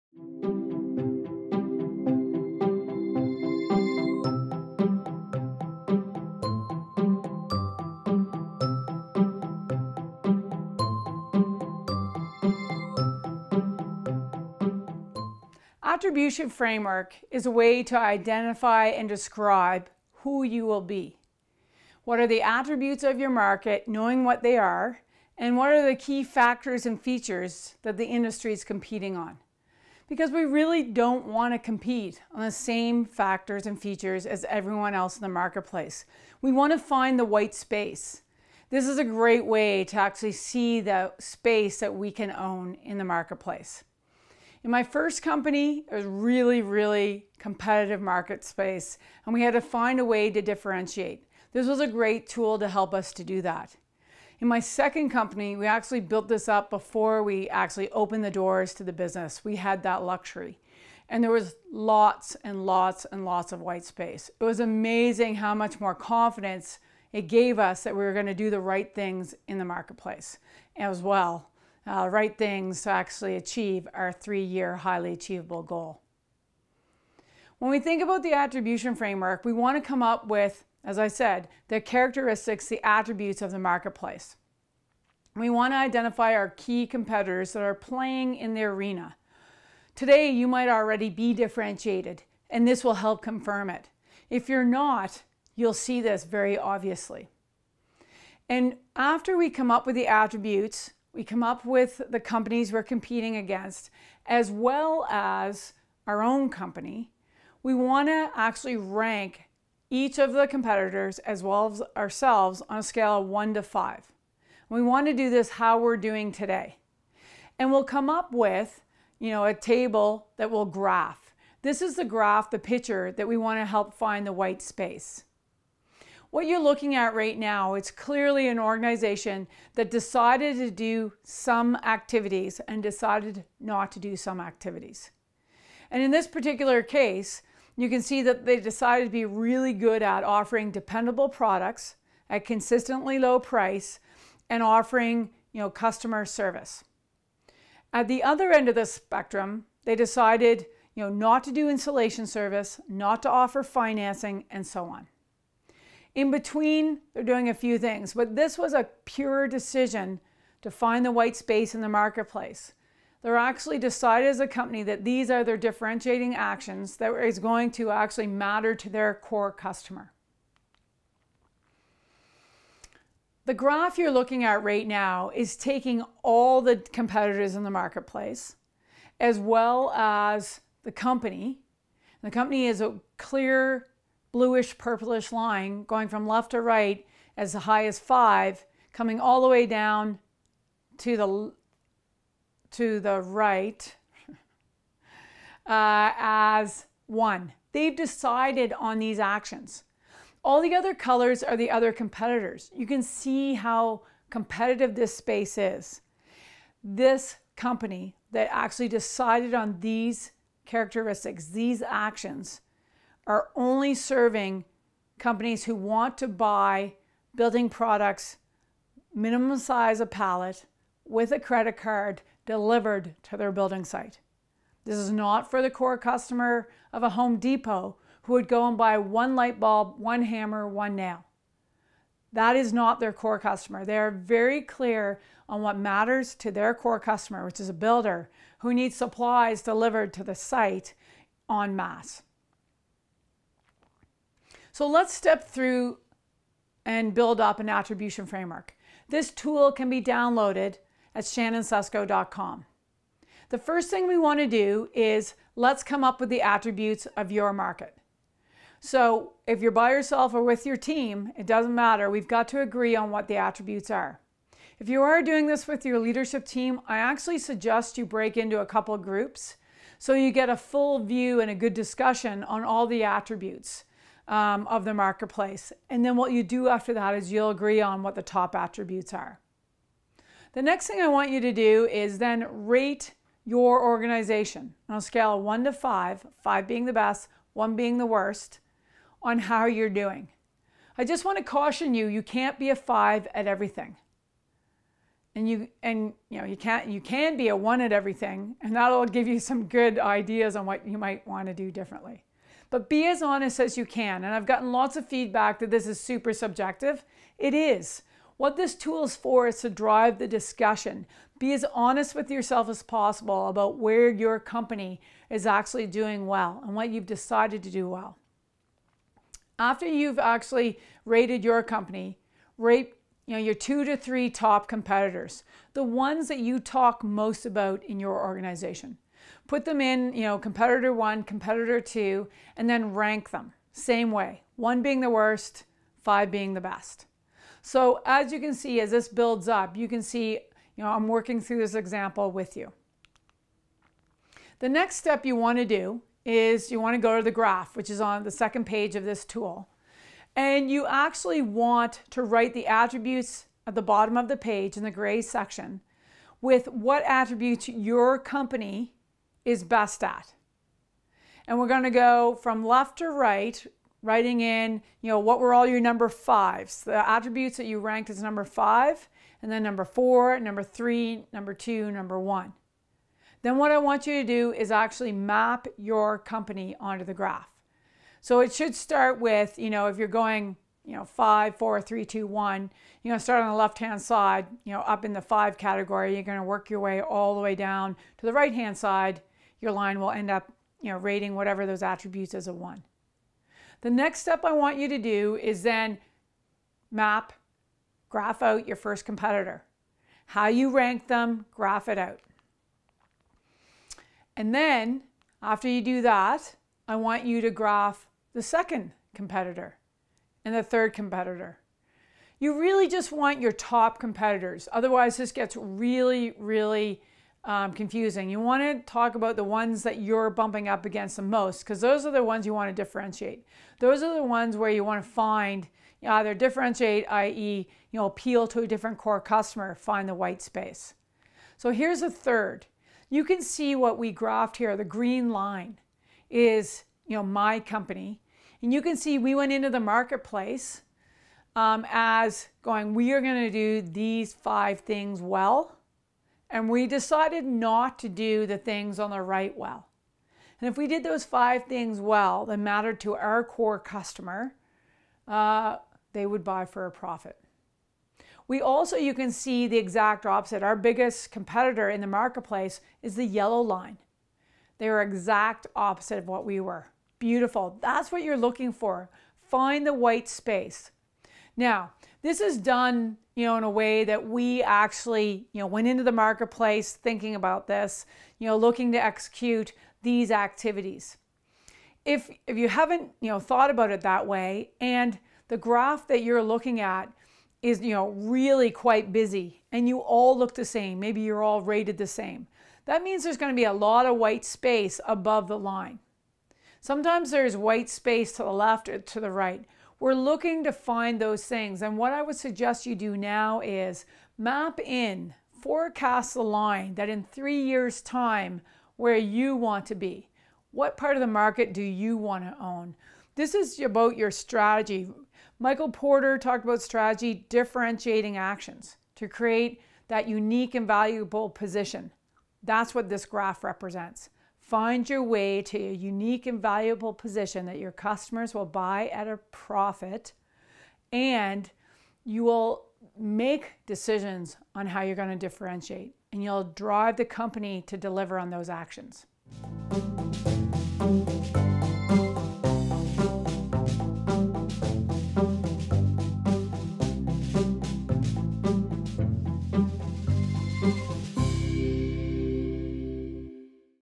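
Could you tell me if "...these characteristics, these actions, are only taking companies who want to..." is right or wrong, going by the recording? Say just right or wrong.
wrong.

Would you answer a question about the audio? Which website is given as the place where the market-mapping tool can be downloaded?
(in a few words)
shannonsusko.com.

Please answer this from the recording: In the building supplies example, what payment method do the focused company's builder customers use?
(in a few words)
Credit card.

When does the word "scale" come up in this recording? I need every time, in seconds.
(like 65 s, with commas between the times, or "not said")
112 s, 285 s.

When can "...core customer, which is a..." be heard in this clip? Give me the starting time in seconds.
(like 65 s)
236 s.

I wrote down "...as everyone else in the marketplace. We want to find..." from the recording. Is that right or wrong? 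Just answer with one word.
right.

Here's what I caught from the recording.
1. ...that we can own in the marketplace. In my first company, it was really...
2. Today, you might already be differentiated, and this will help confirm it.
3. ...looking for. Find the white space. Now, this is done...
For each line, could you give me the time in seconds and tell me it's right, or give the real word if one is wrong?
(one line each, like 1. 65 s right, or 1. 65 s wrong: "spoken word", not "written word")
1. 41 s right
2. 89 s right
3. 468 s right.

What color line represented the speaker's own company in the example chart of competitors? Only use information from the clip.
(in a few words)
Green.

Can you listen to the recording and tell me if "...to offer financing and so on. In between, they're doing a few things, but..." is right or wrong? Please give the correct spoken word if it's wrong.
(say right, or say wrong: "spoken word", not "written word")
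right.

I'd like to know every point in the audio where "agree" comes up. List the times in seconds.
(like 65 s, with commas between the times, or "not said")
262 s, 277 s.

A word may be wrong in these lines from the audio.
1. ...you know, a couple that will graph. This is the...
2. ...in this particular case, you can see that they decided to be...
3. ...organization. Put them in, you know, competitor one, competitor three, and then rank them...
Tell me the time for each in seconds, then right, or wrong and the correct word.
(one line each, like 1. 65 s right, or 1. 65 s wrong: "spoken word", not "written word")
1. 119 s wrong: "table", not "couple"
2. 136 s right
3. 328 s wrong: "two", not "three".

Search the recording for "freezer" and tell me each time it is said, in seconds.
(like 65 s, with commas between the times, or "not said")
not said.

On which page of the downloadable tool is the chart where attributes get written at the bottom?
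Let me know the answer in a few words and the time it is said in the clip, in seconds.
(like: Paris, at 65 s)
Second page, at 348 s.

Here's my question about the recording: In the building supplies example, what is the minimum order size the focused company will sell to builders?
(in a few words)
A pallet.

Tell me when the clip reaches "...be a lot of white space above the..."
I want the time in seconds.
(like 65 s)
493 s.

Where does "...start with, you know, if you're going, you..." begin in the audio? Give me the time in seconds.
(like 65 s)
378 s.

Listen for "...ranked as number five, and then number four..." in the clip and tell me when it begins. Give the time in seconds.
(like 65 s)
367 s.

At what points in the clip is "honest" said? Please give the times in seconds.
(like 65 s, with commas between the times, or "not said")
303 s, 311 s.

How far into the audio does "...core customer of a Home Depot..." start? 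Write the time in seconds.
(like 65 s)
225 s.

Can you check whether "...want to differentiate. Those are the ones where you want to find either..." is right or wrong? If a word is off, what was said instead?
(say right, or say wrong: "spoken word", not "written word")
right.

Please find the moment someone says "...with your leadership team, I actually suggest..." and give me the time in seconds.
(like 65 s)
265 s.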